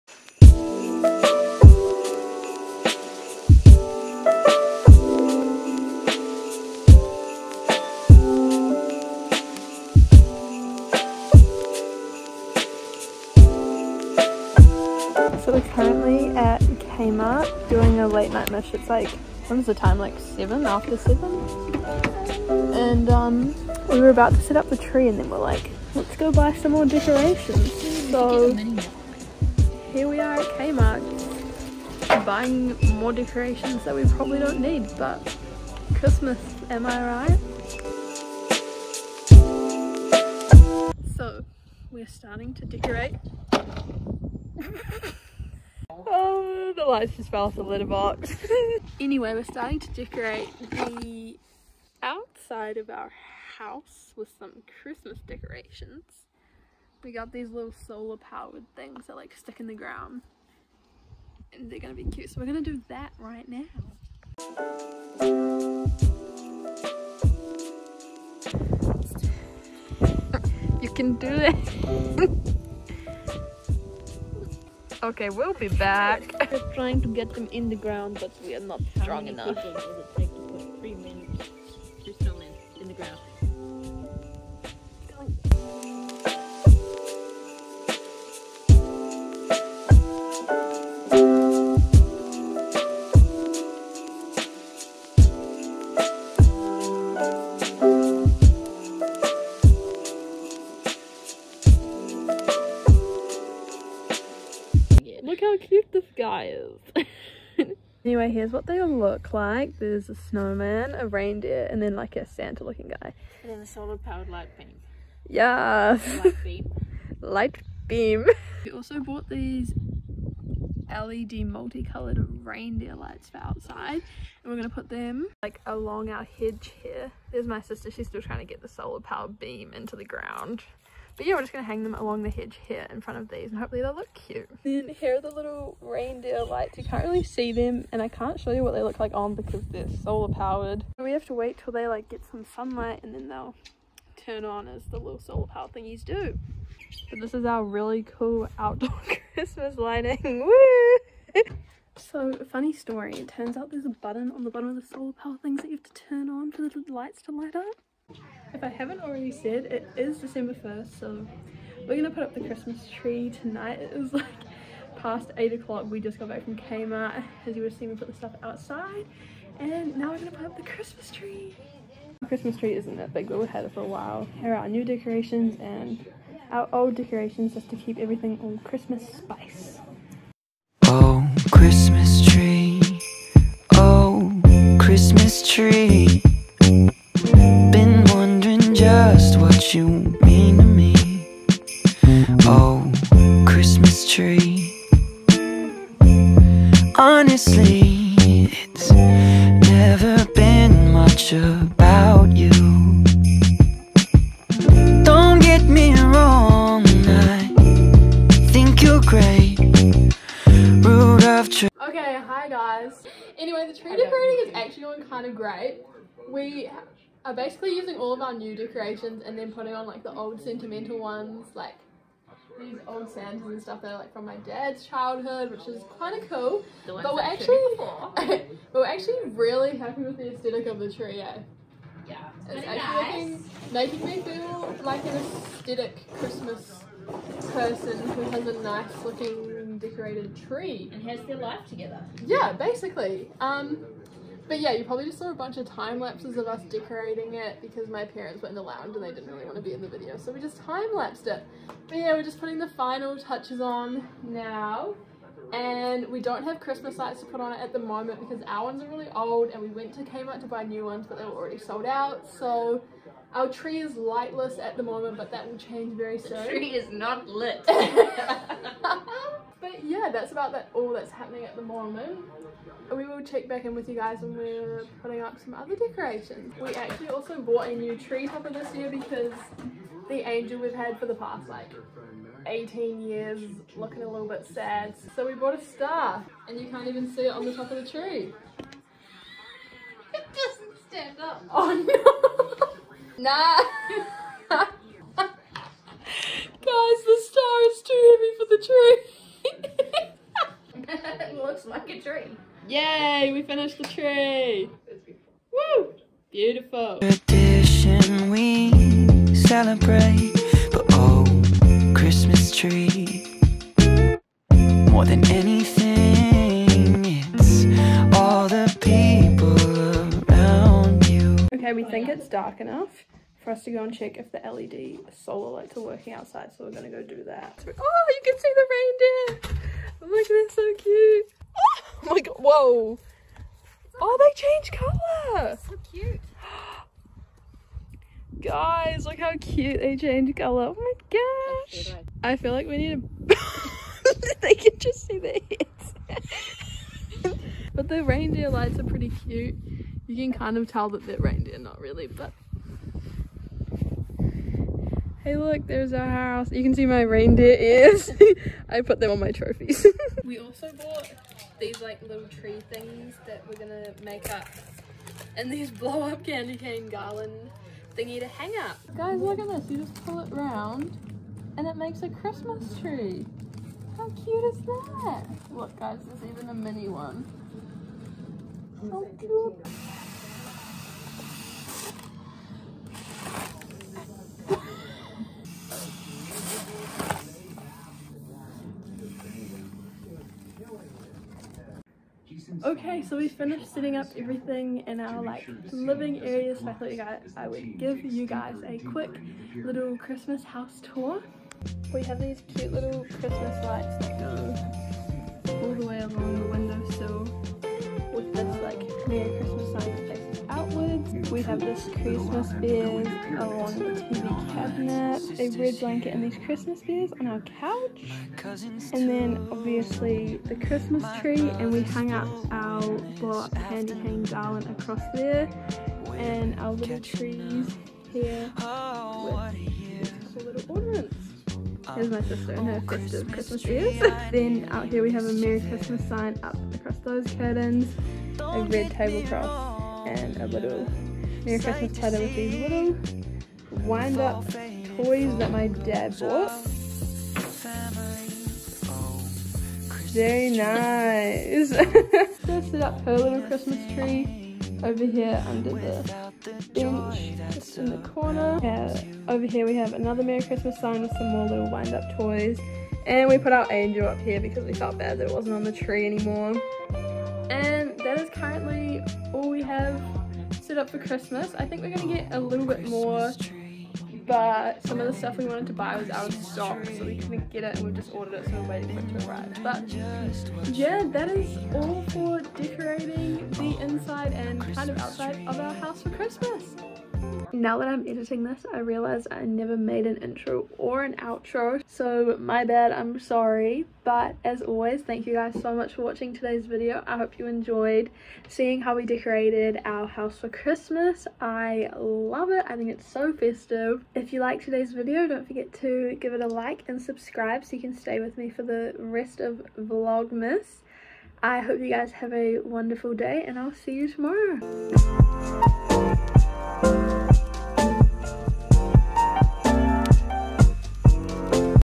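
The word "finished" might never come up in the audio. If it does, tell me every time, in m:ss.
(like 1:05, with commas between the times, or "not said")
5:03, 6:33.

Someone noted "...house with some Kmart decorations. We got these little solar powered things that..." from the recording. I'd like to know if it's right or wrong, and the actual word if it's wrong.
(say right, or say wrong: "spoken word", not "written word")
wrong: "Christmas", not "Kmart".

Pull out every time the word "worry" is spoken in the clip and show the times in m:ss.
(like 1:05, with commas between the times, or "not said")
not said.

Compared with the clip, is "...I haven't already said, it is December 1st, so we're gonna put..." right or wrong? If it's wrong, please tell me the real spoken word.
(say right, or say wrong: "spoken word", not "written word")
right.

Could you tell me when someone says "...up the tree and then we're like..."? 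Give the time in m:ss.
0:24.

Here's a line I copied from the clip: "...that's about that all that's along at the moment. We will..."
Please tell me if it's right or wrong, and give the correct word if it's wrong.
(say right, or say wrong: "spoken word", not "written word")
wrong: "happening", not "along".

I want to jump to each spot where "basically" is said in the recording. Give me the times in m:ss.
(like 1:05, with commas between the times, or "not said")
3:37, 4:02.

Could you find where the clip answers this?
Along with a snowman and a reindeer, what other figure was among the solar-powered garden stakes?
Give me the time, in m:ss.
1:52.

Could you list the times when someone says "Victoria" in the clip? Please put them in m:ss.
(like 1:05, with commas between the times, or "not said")
not said.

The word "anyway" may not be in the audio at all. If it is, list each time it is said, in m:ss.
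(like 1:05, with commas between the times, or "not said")
0:48, 1:48, 3:33.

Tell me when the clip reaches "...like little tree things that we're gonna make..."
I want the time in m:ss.
6:01.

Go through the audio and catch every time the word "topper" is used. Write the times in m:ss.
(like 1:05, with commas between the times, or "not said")
4:38.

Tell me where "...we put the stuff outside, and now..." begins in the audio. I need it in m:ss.
2:47.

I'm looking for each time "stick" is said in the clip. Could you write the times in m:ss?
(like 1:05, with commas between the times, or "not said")
0:59.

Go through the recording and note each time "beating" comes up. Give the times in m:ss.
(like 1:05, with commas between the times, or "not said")
not said.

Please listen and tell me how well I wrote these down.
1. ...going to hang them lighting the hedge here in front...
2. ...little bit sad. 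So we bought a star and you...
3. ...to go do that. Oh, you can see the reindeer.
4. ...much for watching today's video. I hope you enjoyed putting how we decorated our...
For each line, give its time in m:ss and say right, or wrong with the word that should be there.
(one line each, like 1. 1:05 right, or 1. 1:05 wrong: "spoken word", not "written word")
1. 2:11 wrong: "along", not "lighting"
2. 4:44 right
3. 5:26 right
4. 8:15 wrong: "seeing", not "putting".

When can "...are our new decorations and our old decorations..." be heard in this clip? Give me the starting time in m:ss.
2:54.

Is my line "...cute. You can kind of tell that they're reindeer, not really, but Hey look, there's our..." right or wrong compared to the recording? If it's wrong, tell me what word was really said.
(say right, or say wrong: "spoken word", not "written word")
right.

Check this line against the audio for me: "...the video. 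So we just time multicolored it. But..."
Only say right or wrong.
wrong.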